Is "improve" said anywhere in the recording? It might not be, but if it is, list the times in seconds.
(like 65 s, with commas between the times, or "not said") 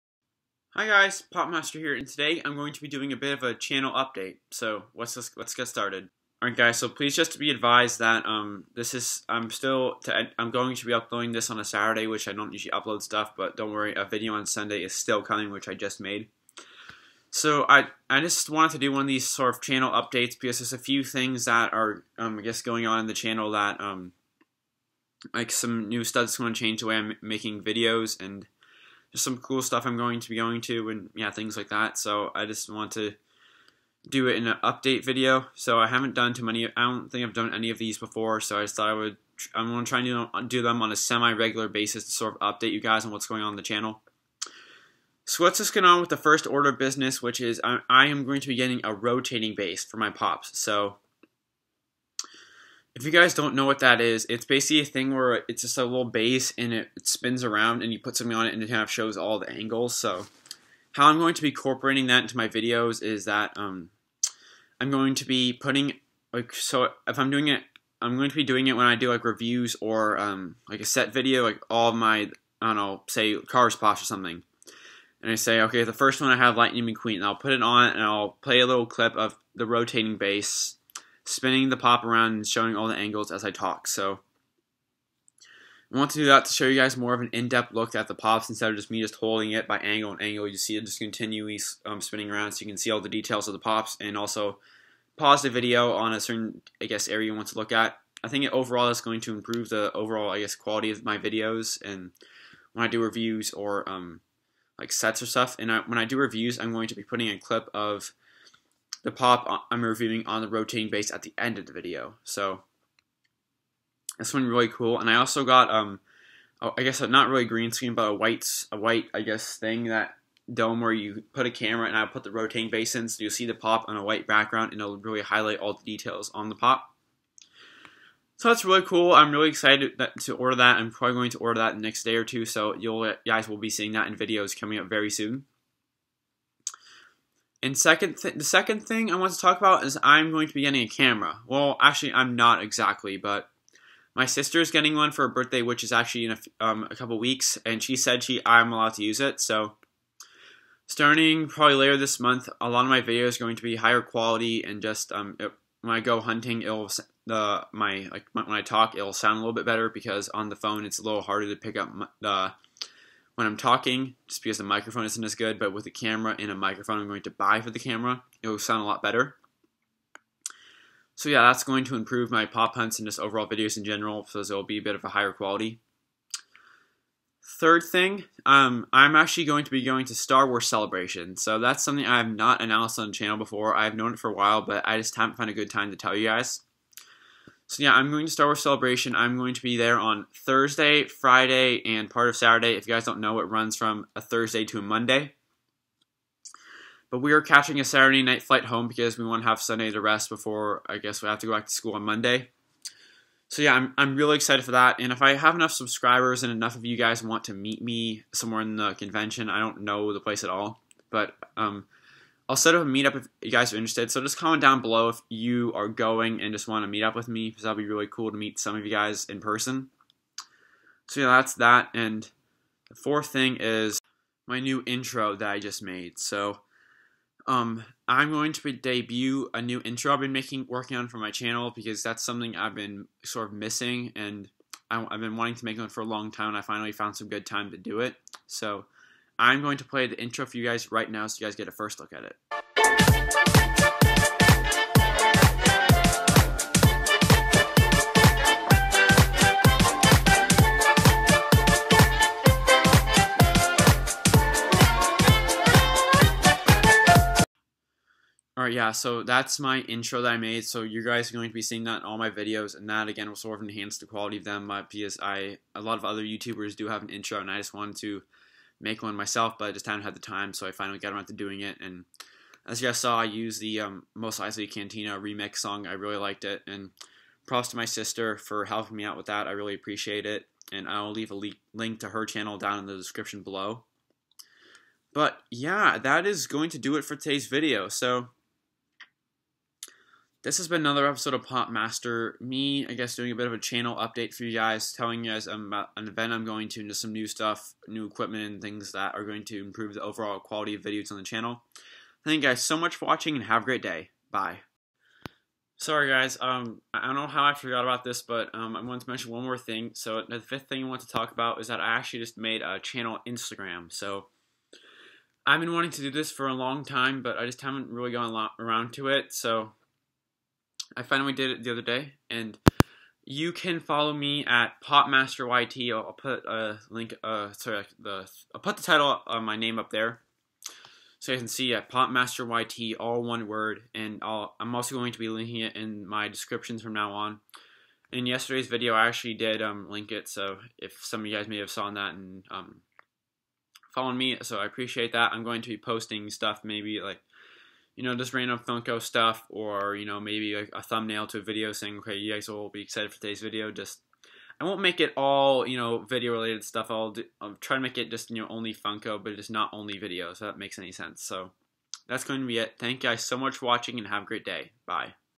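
99 s, 171 s, 299 s.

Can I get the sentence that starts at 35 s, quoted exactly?
So I haven't done too many, I don't think I've done any of these before.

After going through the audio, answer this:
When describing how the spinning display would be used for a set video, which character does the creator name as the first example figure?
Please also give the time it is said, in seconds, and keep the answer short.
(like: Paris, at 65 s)
Lightning McQueen, at 76 s.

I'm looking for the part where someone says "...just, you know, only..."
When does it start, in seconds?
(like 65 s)
358 s.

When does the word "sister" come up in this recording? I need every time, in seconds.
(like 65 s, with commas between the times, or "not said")
144 s, 277 s.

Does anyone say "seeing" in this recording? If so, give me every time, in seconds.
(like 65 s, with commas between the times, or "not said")
133 s, 261 s.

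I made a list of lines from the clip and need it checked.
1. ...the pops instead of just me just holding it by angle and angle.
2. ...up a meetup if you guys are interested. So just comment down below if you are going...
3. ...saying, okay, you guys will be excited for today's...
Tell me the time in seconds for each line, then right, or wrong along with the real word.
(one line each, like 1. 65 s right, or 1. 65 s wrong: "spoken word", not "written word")
1. 88 s right
2. 212 s right
3. 351 s right.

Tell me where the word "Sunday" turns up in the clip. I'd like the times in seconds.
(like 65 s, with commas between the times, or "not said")
14 s, 199 s.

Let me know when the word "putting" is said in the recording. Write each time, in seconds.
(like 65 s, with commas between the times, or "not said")
65 s, 107 s.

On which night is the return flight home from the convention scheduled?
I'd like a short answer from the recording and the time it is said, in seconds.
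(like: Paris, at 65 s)
Saturday night, at 197 s.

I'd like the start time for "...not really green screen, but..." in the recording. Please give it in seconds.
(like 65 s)
117 s.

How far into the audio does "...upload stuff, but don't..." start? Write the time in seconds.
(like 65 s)
12 s.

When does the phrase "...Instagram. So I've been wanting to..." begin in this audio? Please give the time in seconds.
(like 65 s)
313 s.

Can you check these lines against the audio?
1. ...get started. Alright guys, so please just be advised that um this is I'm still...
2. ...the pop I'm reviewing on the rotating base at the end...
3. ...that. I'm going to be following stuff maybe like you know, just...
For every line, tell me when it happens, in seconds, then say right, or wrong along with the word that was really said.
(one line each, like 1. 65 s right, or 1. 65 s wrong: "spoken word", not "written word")
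1. 5 s right
2. 109 s right
3. 345 s wrong: "posting", not "following".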